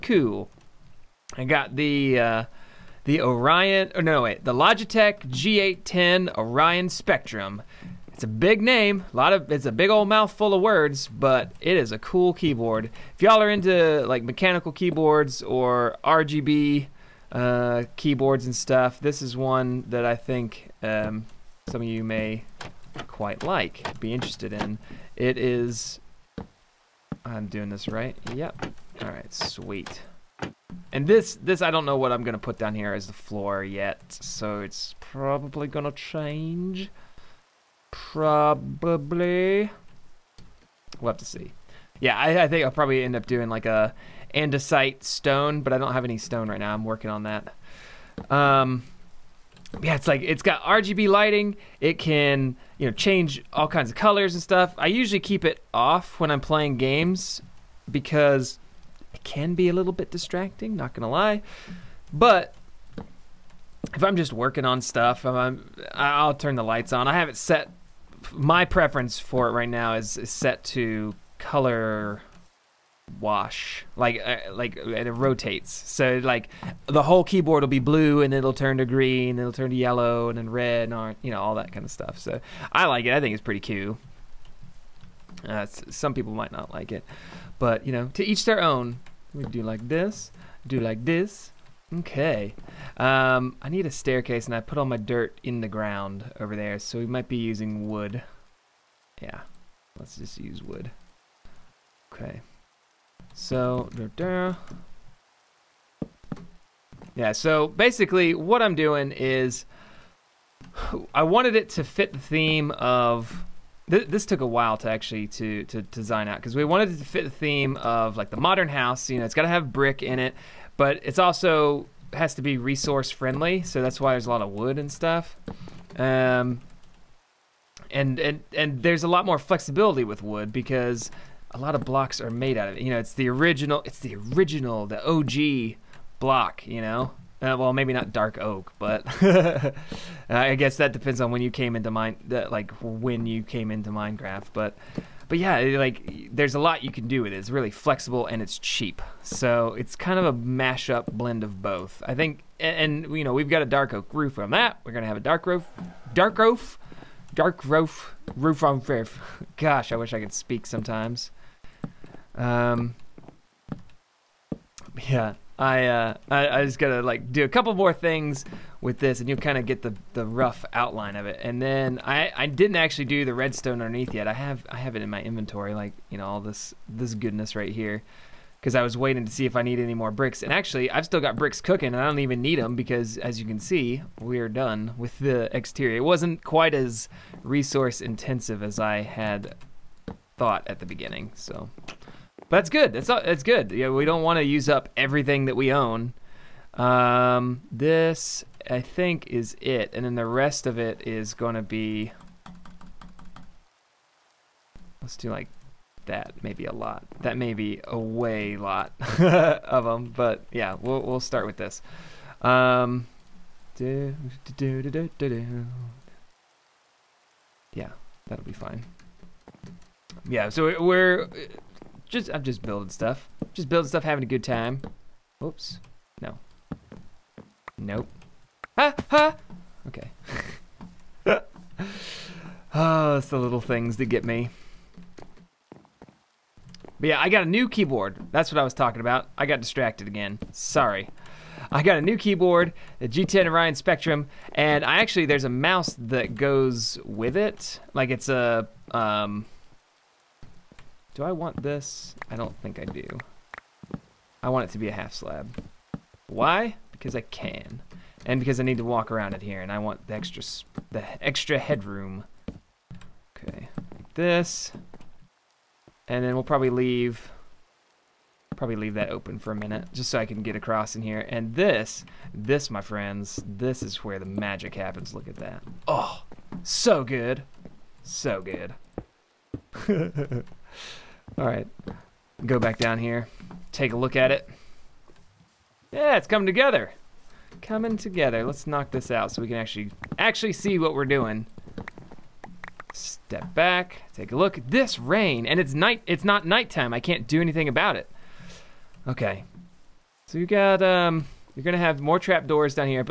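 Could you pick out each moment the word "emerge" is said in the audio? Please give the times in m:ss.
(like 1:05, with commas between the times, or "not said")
not said.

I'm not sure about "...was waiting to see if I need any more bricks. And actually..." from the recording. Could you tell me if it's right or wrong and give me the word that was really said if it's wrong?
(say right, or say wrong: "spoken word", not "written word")
right.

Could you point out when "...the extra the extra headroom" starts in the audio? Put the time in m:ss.
4:20.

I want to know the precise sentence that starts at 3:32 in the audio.
Um, do, do, do, yeah, that'll be fine.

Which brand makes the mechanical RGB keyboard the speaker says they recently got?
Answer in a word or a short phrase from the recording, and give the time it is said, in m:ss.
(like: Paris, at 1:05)
Logitech, at 0:04.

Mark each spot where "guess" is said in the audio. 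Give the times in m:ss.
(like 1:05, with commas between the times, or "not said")
2:20.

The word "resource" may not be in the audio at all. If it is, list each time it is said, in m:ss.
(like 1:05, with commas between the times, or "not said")
2:02, 3:07.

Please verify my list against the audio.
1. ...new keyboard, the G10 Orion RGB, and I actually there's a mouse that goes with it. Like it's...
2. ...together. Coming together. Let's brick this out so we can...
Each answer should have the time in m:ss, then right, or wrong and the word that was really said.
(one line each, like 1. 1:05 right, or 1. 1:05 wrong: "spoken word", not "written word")
1. 4:02 wrong: "Spectrum", not "RGB"
2. 4:46 wrong: "knock", not "brick".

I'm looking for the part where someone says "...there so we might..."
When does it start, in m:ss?
1:36.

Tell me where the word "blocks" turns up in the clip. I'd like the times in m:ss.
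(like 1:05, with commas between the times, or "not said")
2:11, 2:16.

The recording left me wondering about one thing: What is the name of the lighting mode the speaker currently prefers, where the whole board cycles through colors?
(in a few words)
color wash.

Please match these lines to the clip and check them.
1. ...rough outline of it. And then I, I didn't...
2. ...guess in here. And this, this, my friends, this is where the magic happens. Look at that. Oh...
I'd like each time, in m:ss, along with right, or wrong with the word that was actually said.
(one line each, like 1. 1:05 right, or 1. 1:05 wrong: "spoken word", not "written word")
1. 2:50 right
2. 4:30 wrong: "across", not "guess".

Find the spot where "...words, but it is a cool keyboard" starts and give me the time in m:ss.
0:10.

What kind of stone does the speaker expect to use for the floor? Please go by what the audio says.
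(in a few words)
andesite.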